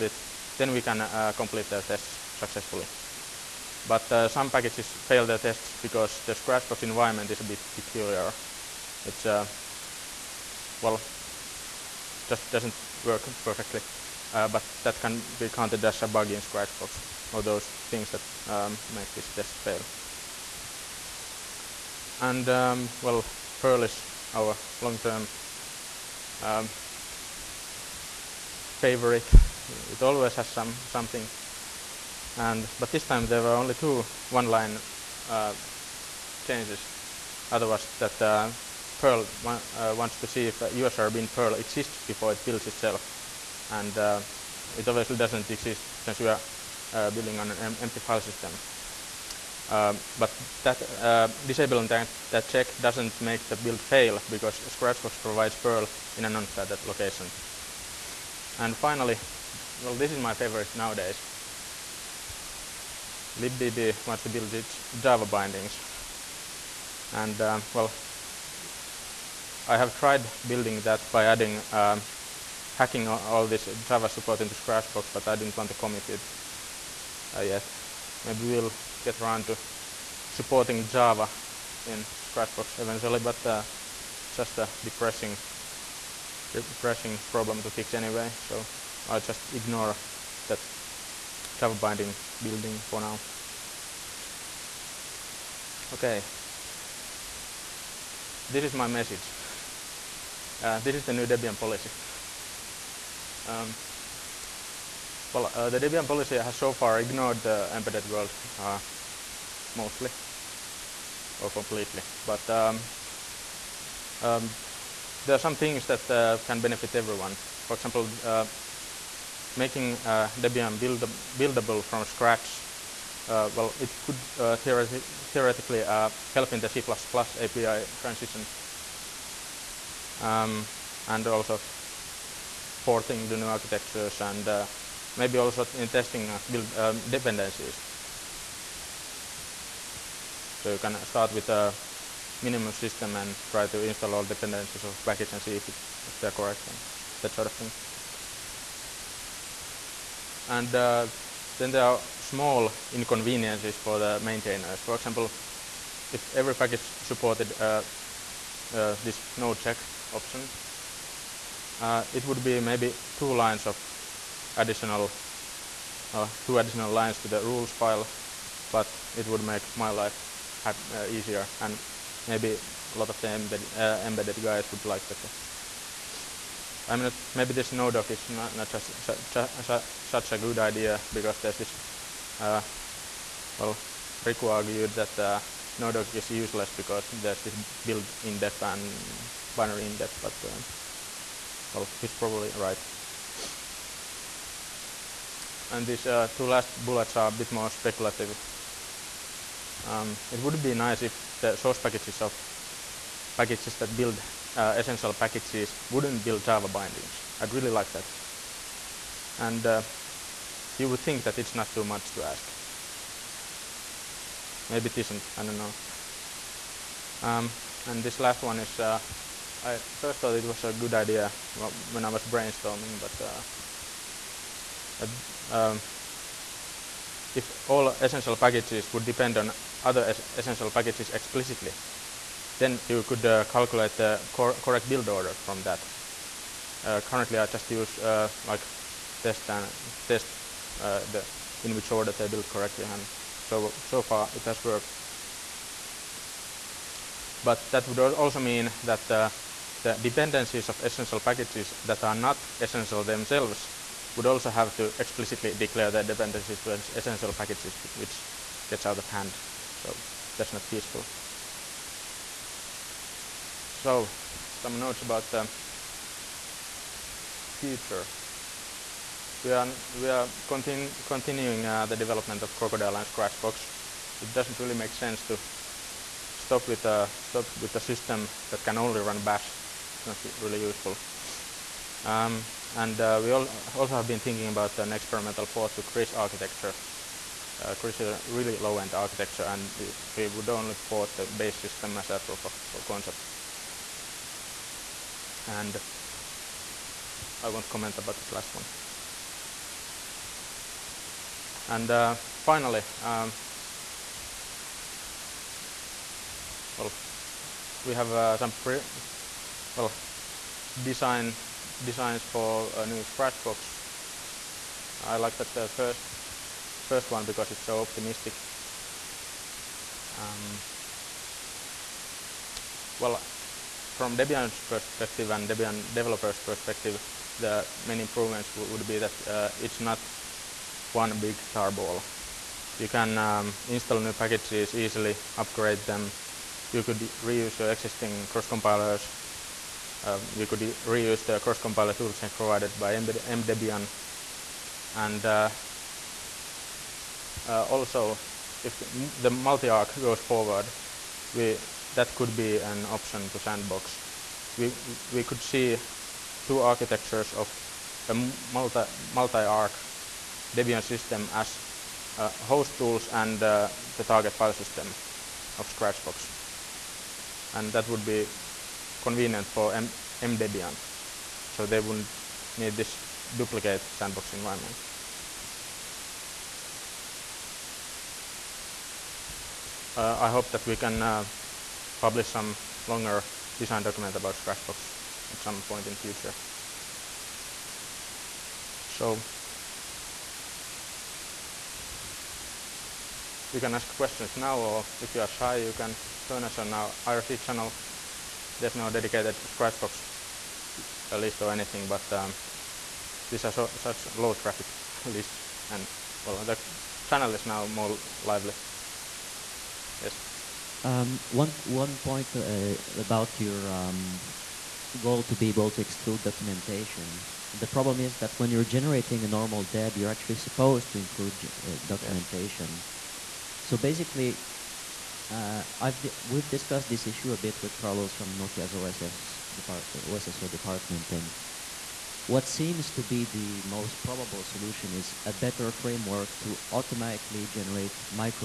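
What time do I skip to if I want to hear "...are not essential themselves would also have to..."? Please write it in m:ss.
4:12.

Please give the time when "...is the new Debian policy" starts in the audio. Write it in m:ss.
1:40.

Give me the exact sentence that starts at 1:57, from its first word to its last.
For example, uh, making uh, Debian build buildable from scratch, uh, well, it could theoretically help in the C++ API transition.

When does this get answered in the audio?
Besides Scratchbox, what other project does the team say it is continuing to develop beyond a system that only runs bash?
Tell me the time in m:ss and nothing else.
4:32.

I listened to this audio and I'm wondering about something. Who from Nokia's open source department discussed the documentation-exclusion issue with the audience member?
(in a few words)
Carlos.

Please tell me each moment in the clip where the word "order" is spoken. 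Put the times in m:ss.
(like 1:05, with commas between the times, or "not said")
3:55, 4:01.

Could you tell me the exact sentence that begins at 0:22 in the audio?
And, um, well, Perl is our long-term um, favorite.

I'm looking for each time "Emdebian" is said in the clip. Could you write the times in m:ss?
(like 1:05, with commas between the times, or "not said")
5:43, 6:10.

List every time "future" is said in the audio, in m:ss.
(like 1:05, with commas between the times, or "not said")
4:27, 6:25.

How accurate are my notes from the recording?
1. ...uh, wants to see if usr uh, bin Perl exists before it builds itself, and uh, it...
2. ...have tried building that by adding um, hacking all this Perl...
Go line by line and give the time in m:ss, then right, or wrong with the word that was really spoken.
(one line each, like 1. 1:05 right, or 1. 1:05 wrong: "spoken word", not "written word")
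1. 0:39 right
2. 1:09 wrong: "Java", not "Perl".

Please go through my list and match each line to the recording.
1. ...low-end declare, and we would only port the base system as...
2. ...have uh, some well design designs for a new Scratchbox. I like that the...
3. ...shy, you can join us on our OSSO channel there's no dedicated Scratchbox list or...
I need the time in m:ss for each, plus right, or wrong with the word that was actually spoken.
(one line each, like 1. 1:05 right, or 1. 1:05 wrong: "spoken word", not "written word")
1. 4:48 wrong: "architecture", not "declare"
2. 5:07 right
3. 6:35 wrong: "IRC", not "OSSO".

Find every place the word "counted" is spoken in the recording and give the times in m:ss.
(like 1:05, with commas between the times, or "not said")
0:15.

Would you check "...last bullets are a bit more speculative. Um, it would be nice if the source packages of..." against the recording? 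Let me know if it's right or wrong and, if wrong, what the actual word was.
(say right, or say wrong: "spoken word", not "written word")
right.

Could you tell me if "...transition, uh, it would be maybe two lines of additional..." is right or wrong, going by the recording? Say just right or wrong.
wrong.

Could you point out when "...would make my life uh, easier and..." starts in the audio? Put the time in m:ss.
2:49.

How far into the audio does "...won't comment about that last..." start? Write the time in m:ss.
4:57.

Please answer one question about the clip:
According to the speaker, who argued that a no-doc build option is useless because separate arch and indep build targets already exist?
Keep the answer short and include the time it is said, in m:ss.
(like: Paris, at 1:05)
Riku, at 3:04.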